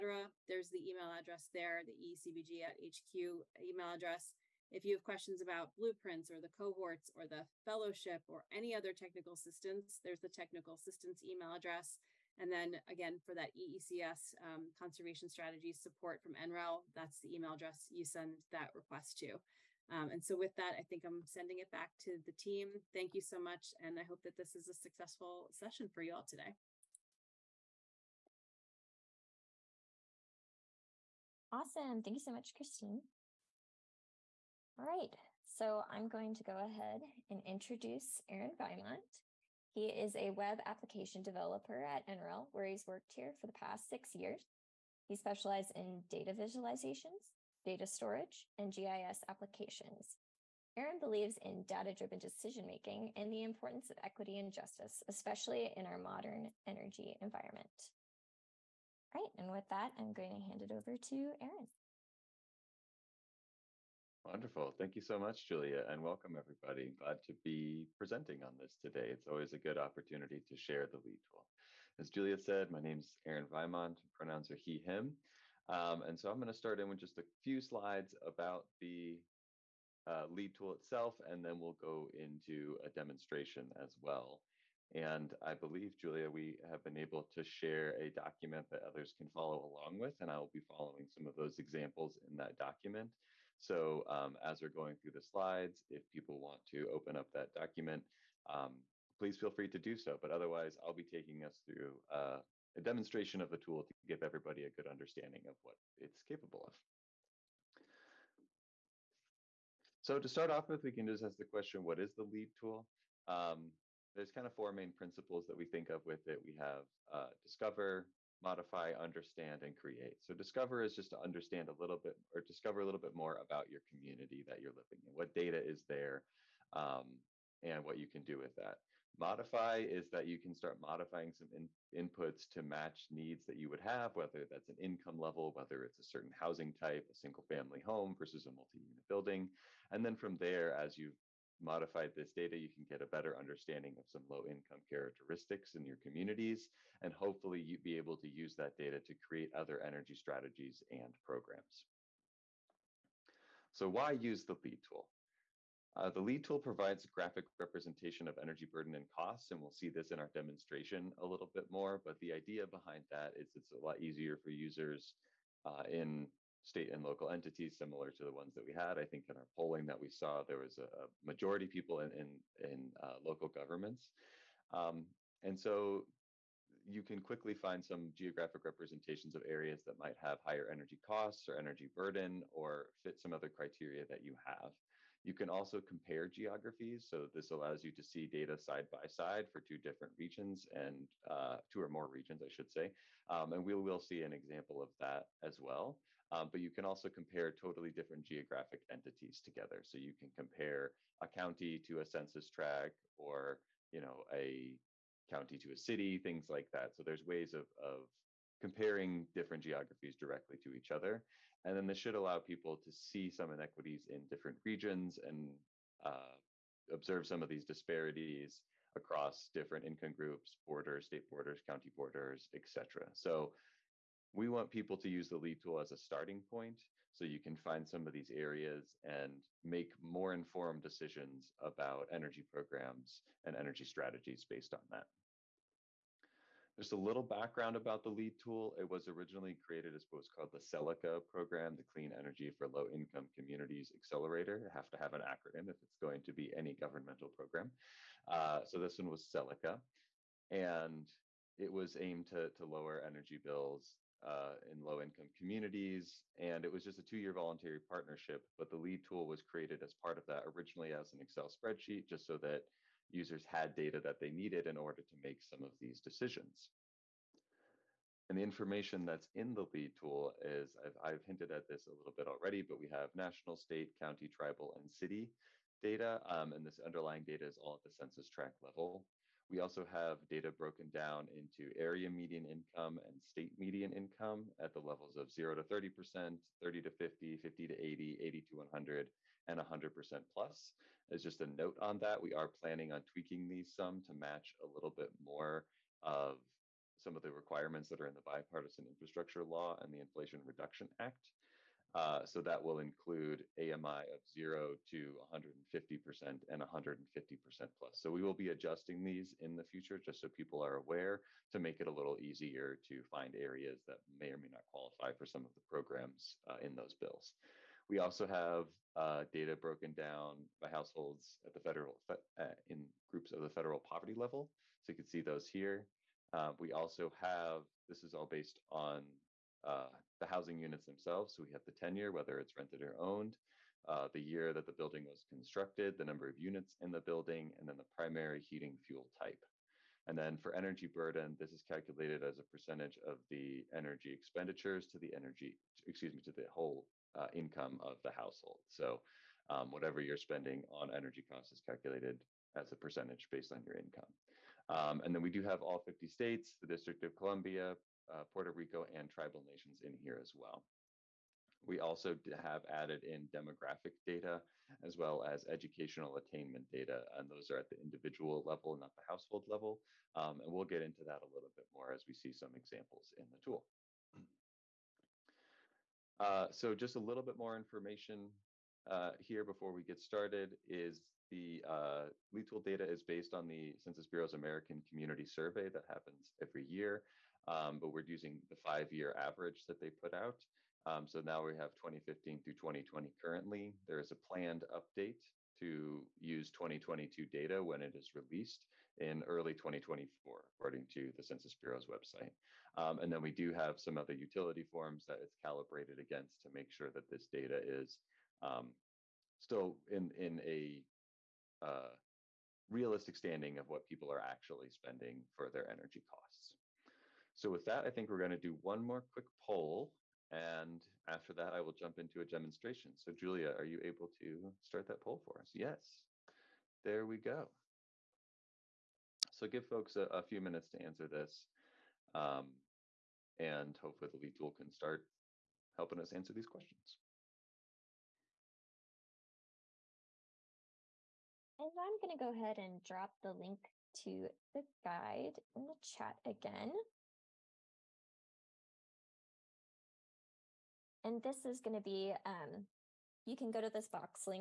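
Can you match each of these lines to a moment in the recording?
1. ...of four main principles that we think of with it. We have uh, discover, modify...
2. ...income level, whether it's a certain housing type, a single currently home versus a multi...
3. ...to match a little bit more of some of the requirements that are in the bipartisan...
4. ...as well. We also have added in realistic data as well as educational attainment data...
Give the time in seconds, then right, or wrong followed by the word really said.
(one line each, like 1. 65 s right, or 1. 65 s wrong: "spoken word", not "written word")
1. 114 s right
2. 134 s wrong: "family", not "currently"
3. 294 s right
4. 360 s wrong: "demographic", not "realistic".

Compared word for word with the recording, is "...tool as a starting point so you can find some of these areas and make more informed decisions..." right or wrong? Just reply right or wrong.
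right.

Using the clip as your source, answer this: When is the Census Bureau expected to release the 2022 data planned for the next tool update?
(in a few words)
early 2024.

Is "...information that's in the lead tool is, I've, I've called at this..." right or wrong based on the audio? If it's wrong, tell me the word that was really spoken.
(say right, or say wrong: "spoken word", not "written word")
wrong: "hinted", not "called".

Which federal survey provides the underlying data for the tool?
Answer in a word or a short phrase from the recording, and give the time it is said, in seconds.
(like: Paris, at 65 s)
American Community Survey, at 384 s.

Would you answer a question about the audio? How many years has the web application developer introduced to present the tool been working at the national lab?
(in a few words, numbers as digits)
6.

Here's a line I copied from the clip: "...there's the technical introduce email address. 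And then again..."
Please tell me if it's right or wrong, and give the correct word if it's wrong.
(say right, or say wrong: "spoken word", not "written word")
wrong: "assistance", not "introduce".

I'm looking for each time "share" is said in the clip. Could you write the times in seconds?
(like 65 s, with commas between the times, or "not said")
70 s, 87 s.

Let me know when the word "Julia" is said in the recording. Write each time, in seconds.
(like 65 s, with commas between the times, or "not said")
65 s, 72 s, 85 s, 423 s.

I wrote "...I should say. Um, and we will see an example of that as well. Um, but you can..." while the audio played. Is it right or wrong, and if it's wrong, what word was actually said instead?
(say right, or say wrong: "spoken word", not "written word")
right.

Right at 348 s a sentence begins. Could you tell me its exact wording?
So um, whatever you're spending on energy costs is calculated as a percentage based on your income.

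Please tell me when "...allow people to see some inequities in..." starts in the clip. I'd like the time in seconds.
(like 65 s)
212 s.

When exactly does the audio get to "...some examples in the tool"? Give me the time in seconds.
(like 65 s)
372 s.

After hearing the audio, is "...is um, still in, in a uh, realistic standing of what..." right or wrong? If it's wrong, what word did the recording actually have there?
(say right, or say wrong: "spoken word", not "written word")
right.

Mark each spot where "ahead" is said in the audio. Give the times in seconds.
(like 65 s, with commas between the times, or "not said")
36 s, 442 s.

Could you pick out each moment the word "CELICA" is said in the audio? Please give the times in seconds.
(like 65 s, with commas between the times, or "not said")
240 s, 249 s.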